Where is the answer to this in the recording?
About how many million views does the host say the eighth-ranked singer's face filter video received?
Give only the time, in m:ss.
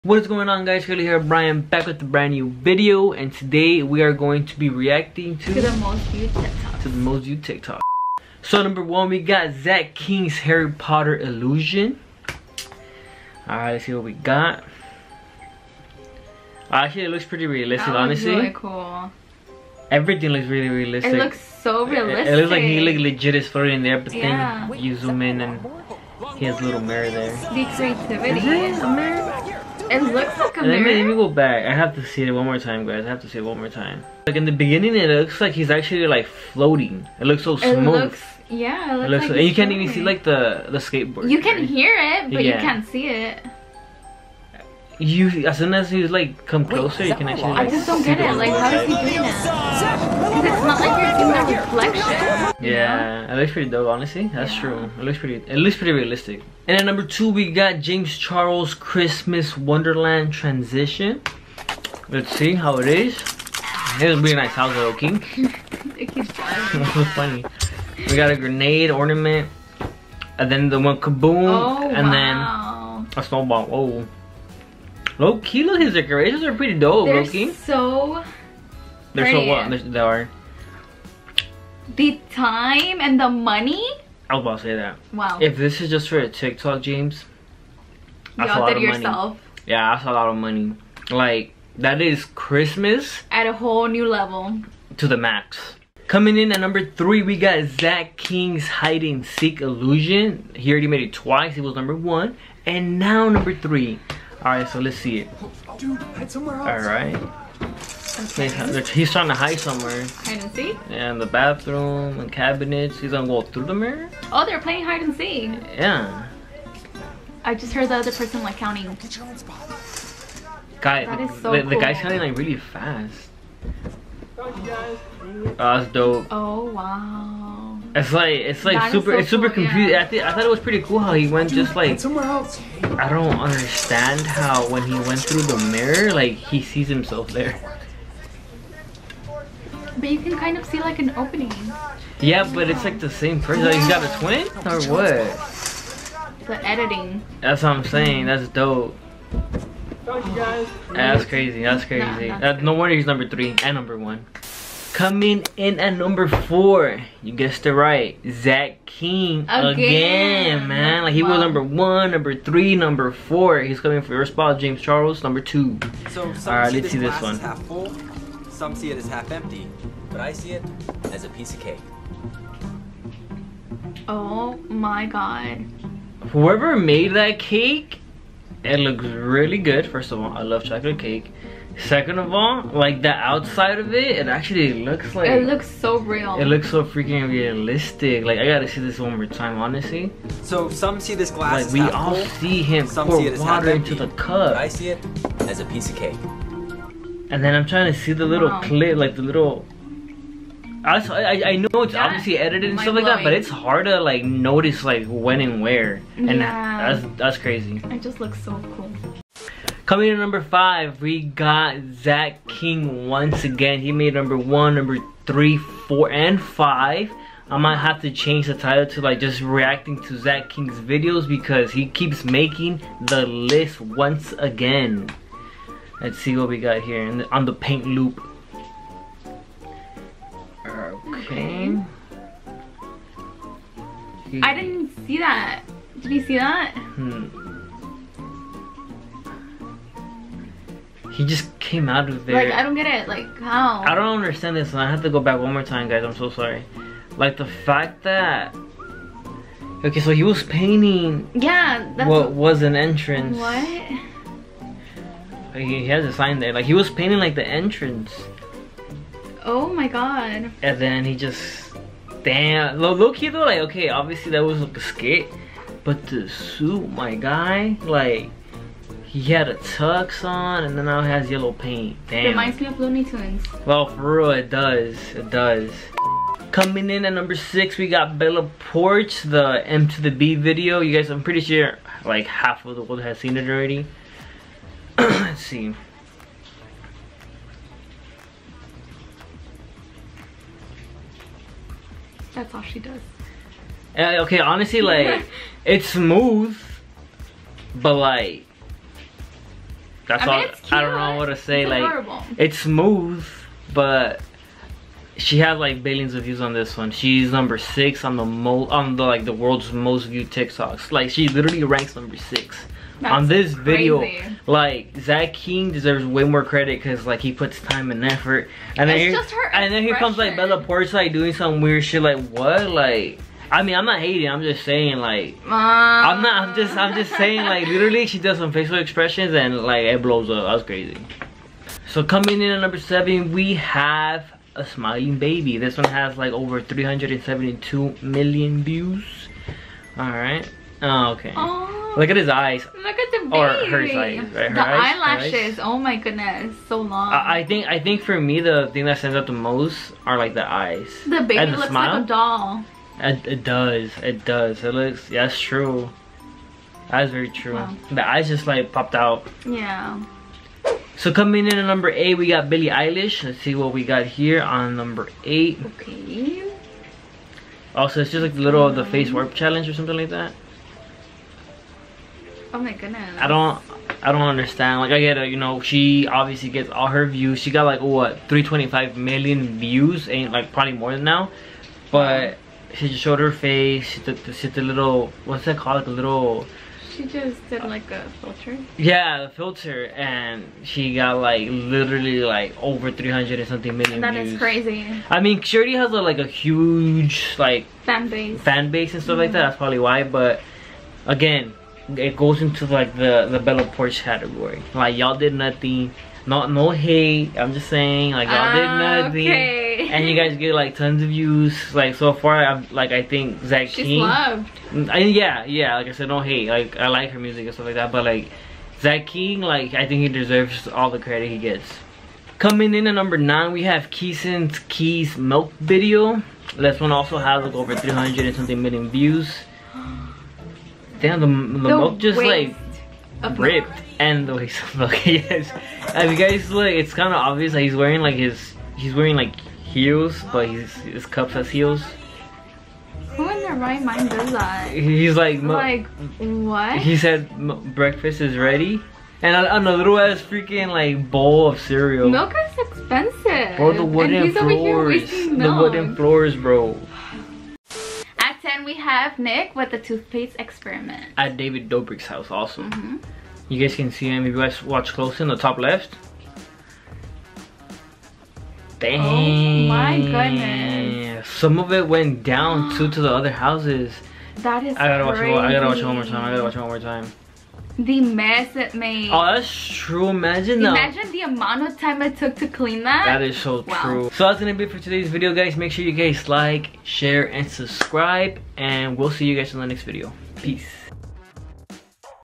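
6:18.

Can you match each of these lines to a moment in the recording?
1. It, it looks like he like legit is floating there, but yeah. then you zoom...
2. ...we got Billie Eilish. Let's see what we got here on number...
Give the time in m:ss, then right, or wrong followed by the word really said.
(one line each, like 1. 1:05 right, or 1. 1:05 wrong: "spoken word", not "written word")
1. 0:22 right
2. 6:02 right.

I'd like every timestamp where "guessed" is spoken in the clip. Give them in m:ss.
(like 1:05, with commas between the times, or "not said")
2:37.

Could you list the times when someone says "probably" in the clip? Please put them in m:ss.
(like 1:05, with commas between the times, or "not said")
6:20, 6:39.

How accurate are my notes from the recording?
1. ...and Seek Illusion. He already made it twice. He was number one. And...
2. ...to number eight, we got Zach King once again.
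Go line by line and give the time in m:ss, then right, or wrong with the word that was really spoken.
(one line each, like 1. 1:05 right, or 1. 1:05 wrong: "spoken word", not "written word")
1. 1:39 right
2. 3:30 wrong: "five", not "eight".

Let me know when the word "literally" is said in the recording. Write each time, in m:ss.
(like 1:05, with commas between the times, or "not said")
5:11, 5:27, 6:31.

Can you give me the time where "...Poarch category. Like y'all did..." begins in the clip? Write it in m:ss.
6:43.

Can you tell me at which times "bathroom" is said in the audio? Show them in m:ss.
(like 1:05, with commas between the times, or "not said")
1:51.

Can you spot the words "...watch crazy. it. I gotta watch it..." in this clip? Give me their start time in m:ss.
7:55.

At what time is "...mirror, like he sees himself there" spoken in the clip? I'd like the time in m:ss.
2:15.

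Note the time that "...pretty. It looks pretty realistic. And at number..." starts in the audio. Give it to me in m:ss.
0:55.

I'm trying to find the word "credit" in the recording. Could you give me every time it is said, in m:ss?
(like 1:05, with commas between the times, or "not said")
5:16, 7:00.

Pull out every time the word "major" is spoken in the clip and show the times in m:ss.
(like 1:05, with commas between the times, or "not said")
not said.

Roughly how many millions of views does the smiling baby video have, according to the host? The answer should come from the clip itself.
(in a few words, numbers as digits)
372 million.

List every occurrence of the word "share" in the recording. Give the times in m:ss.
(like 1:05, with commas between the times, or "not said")
8:06.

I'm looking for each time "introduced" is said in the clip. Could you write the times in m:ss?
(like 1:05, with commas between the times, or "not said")
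not said.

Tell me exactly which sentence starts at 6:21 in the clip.
But she just showed her face.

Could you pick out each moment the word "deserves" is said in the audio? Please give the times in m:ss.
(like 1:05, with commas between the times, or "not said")
5:15, 7:00.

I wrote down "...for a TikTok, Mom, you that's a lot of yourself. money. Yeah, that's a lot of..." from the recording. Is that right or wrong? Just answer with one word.
wrong.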